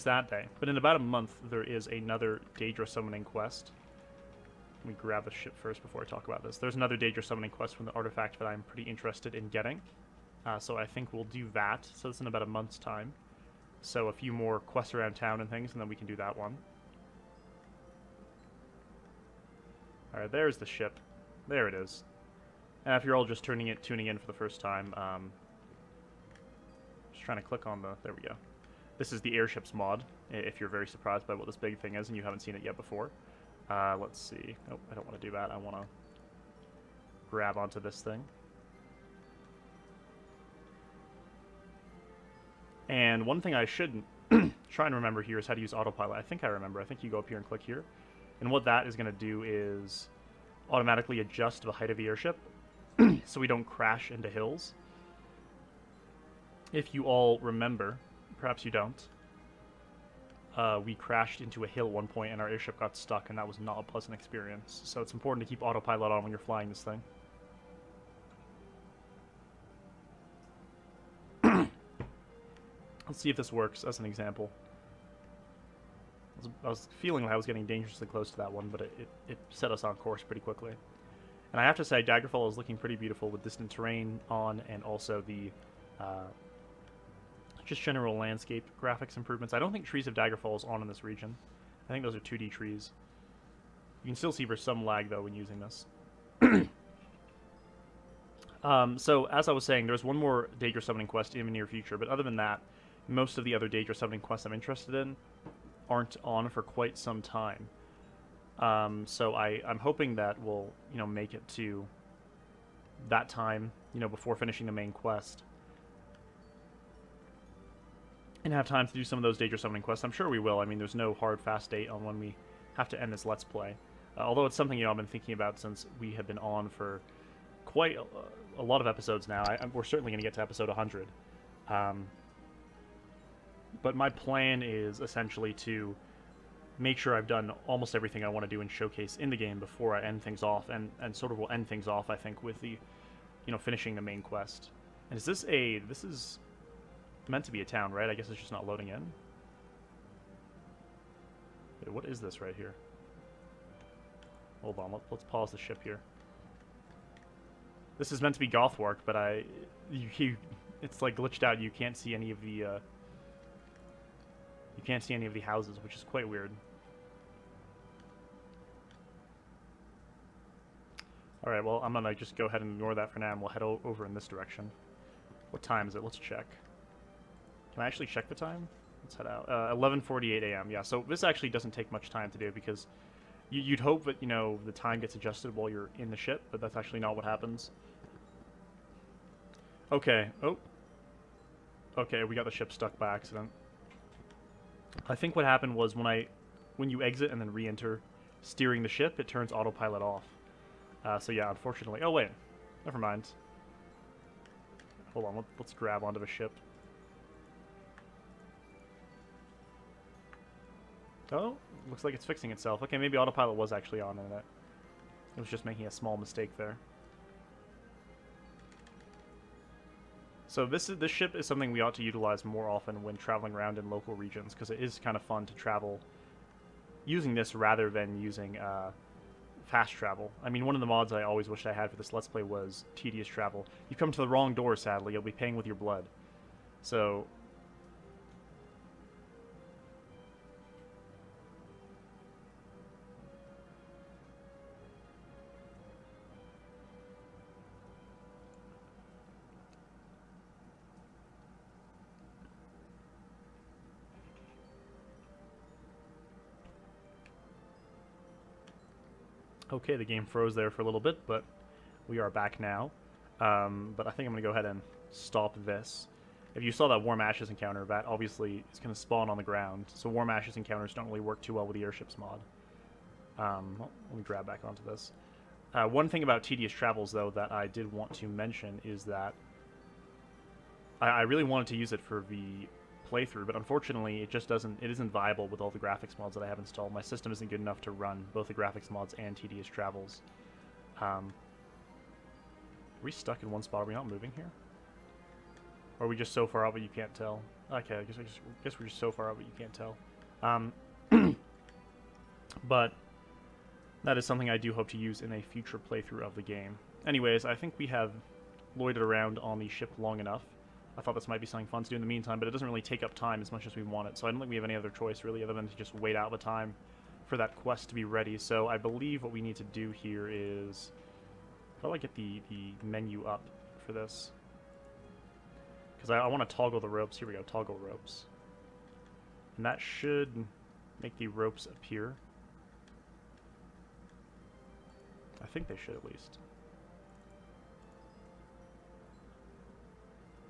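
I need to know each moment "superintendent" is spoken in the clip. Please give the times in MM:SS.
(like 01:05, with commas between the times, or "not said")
not said.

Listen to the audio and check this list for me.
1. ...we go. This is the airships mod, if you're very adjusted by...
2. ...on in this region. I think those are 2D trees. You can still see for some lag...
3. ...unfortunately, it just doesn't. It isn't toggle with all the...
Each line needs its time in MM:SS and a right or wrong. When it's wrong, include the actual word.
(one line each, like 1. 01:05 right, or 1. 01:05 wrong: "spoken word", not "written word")
1. 00:28 wrong: "surprised", not "adjusted"
2. 01:30 right
3. 04:43 wrong: "viable", not "toggle".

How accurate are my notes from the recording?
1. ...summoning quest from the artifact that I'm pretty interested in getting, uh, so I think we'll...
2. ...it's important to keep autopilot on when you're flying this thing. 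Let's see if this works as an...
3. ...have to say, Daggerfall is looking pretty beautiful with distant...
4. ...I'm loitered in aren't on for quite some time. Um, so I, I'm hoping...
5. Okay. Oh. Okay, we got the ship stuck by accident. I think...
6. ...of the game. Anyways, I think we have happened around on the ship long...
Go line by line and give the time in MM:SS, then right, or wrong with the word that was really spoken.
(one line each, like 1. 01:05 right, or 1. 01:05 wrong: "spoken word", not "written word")
1. 00:07 right
2. 01:04 right
3. 01:21 right
4. 01:44 wrong: "interested", not "loitered"
5. 03:09 right
6. 05:06 wrong: "loitered", not "happened".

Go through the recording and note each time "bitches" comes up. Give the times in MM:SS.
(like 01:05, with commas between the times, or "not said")
not said.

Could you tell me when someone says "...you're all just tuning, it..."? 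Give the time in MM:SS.
00:23.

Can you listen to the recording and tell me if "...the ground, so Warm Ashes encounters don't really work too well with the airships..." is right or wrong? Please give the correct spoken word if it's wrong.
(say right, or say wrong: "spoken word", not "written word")
right.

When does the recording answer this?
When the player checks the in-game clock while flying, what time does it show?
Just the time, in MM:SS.
02:59.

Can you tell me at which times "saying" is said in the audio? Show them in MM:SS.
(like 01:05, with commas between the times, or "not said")
01:39.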